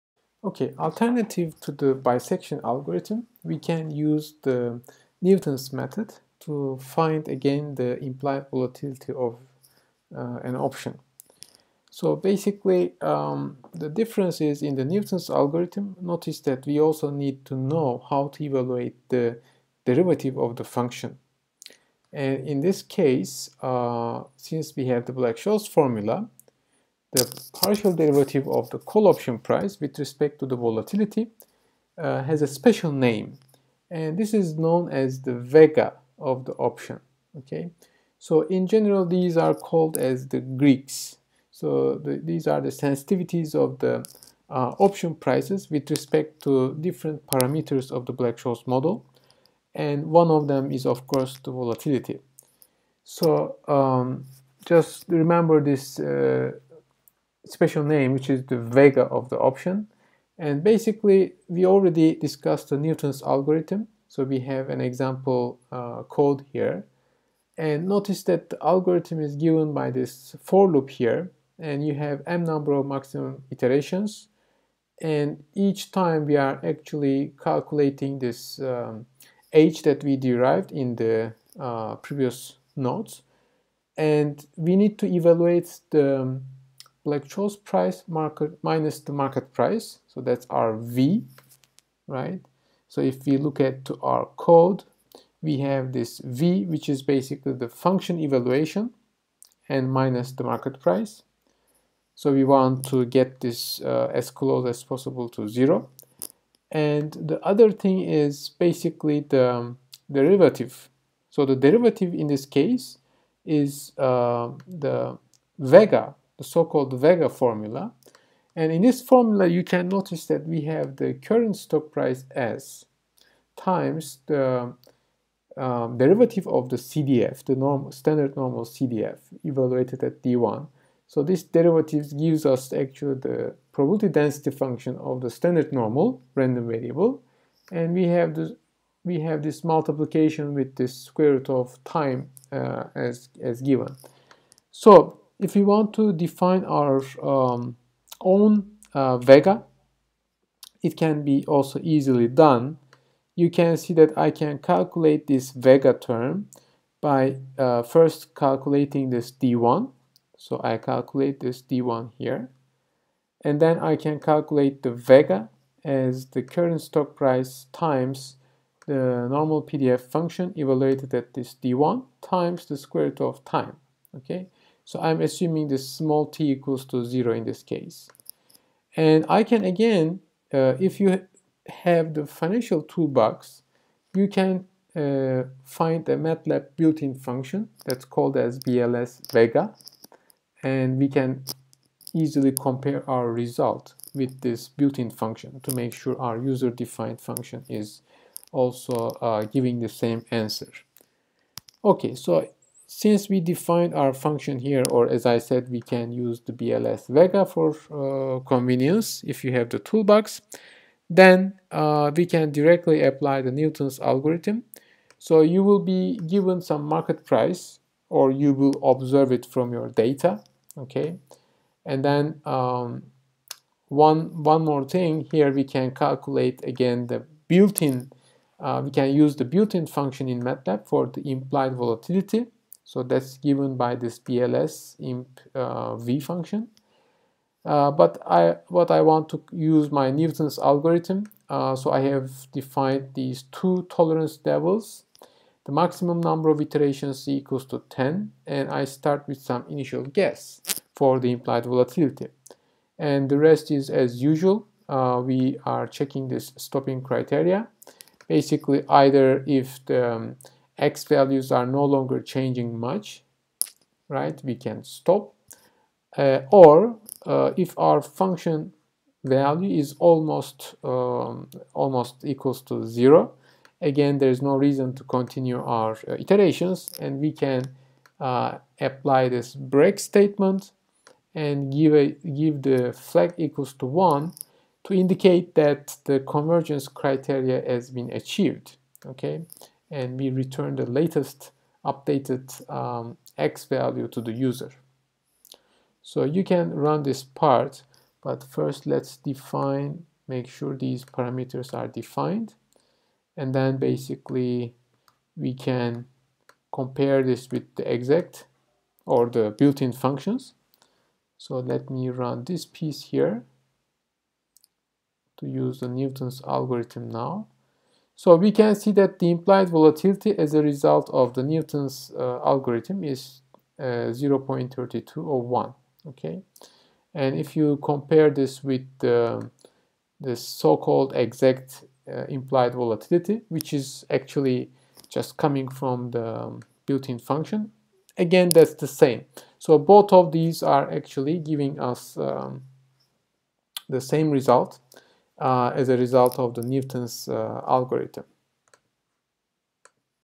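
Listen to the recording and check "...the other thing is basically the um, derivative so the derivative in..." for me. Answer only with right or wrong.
right.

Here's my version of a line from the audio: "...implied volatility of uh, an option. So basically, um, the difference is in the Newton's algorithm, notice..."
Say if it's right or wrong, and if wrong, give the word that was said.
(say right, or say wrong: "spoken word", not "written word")
right.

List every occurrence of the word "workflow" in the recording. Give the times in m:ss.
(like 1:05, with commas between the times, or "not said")
not said.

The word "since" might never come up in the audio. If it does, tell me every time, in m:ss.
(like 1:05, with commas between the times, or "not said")
0:24, 3:22.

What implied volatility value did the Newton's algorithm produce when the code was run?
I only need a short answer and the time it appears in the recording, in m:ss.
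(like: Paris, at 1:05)
0.3201, at 5:24.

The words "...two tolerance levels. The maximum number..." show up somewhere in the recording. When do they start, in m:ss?
4:03.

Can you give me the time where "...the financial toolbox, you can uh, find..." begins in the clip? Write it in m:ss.
3:02.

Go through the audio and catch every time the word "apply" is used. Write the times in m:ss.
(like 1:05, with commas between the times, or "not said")
3:33, 4:38.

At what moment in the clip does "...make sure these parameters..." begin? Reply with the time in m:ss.
5:00.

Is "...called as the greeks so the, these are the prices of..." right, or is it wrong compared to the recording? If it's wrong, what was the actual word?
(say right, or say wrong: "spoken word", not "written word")
wrong: "sensitivities", not "prices".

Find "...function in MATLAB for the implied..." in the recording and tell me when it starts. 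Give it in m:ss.
3:49.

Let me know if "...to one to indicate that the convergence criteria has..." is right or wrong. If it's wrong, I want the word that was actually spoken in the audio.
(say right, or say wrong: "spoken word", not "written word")
right.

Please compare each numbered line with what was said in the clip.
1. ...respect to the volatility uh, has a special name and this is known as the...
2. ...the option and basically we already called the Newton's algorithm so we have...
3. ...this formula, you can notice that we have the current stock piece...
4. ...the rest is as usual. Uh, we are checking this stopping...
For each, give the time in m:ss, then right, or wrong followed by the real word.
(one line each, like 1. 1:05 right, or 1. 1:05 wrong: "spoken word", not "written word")
1. 0:29 right
2. 0:59 wrong: "discussed", not "called"
3. 1:58 wrong: "price", not "piece"
4. 4:13 right.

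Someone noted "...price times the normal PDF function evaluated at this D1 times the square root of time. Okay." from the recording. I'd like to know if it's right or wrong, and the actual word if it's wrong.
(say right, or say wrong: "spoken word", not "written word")
right.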